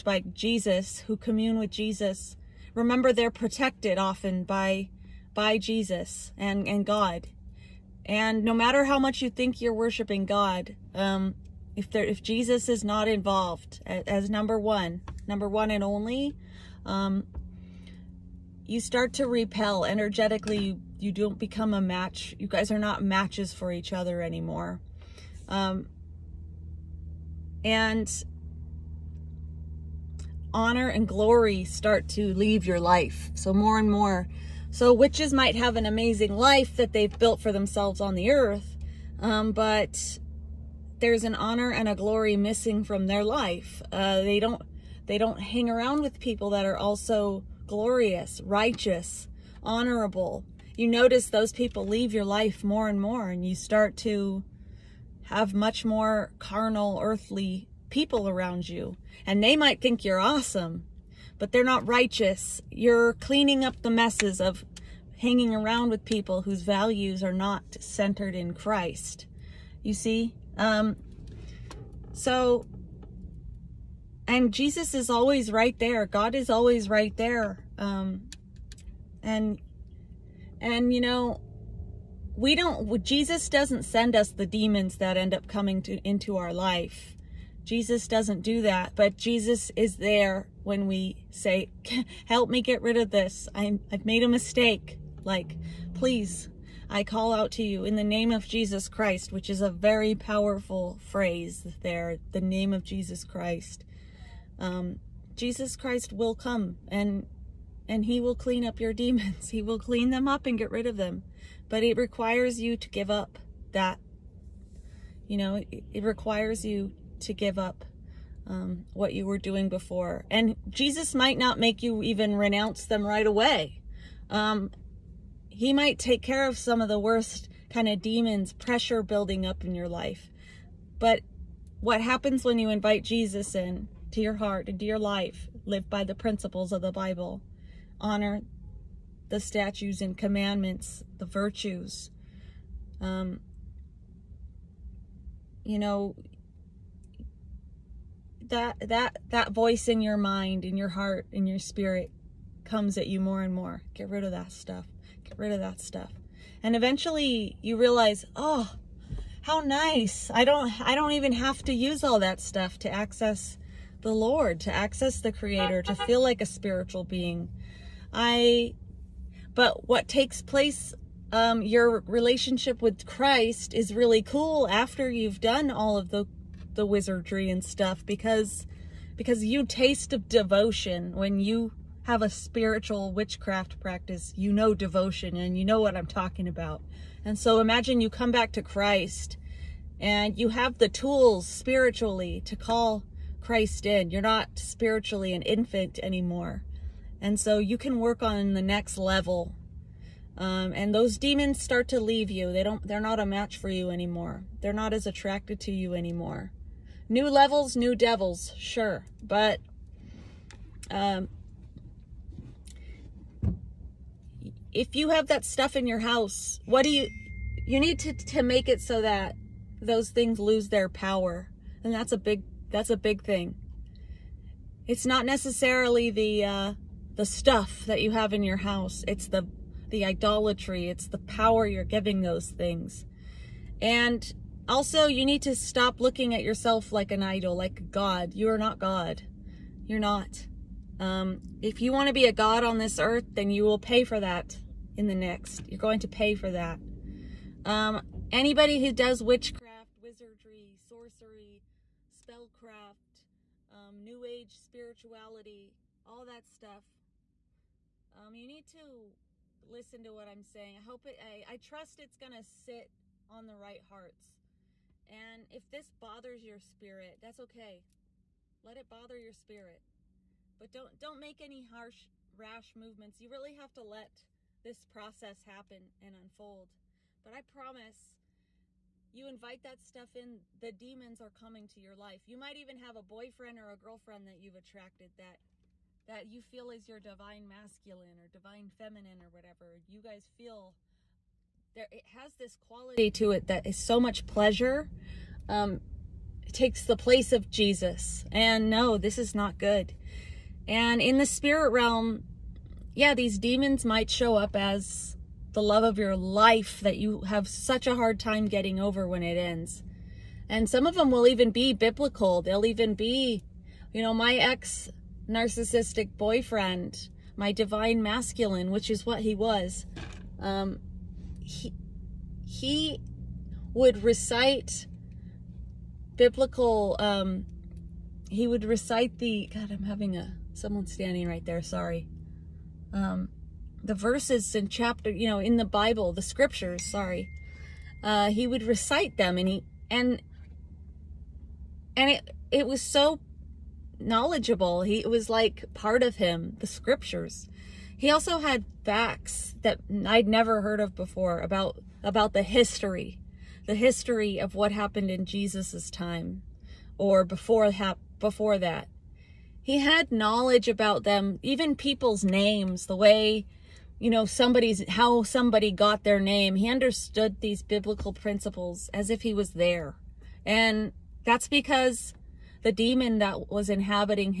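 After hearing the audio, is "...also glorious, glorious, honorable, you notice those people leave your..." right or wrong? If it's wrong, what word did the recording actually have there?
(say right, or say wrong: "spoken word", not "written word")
wrong: "righteous", not "glorious".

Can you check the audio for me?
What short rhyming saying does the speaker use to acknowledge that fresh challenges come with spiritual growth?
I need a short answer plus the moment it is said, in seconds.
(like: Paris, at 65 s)
New levels, new devils, at 207 s.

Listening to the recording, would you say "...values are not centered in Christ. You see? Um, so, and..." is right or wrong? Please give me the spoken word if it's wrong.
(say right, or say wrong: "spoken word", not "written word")
right.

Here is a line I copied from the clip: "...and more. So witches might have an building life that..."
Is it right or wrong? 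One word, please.
wrong.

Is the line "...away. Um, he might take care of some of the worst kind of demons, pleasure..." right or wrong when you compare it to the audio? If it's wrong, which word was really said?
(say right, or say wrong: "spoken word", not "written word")
wrong: "pressure", not "pleasure".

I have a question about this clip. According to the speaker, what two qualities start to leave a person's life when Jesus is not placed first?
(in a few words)
honor and glory.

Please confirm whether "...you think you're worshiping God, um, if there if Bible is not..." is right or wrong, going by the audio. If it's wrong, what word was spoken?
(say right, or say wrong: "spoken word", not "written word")
wrong: "Jesus", not "Bible".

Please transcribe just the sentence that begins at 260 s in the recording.
I hope it, I, I trust it's going to sit on the right hearts.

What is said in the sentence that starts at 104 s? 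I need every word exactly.
Um, Jesus Christ will come and and he will clean up your demons.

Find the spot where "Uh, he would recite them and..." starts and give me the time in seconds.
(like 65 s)
338 s.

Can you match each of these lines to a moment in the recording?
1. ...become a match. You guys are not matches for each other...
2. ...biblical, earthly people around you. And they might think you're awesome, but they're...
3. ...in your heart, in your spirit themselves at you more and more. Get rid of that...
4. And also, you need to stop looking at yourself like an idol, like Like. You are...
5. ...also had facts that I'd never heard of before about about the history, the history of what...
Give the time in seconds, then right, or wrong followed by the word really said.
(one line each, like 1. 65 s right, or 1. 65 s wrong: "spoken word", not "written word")
1. 21 s right
2. 56 s wrong: "carnal", not "biblical"
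3. 150 s wrong: "comes", not "themselves"
4. 233 s wrong: "God", not "Like"
5. 348 s right.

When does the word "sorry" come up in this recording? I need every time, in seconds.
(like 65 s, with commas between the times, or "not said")
331 s, 336 s.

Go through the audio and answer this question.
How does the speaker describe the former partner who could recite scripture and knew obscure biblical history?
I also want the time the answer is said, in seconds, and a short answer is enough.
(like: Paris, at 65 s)
narcissistic boyfriend, at 315 s.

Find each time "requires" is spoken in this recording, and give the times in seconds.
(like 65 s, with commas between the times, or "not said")
111 s, 116 s.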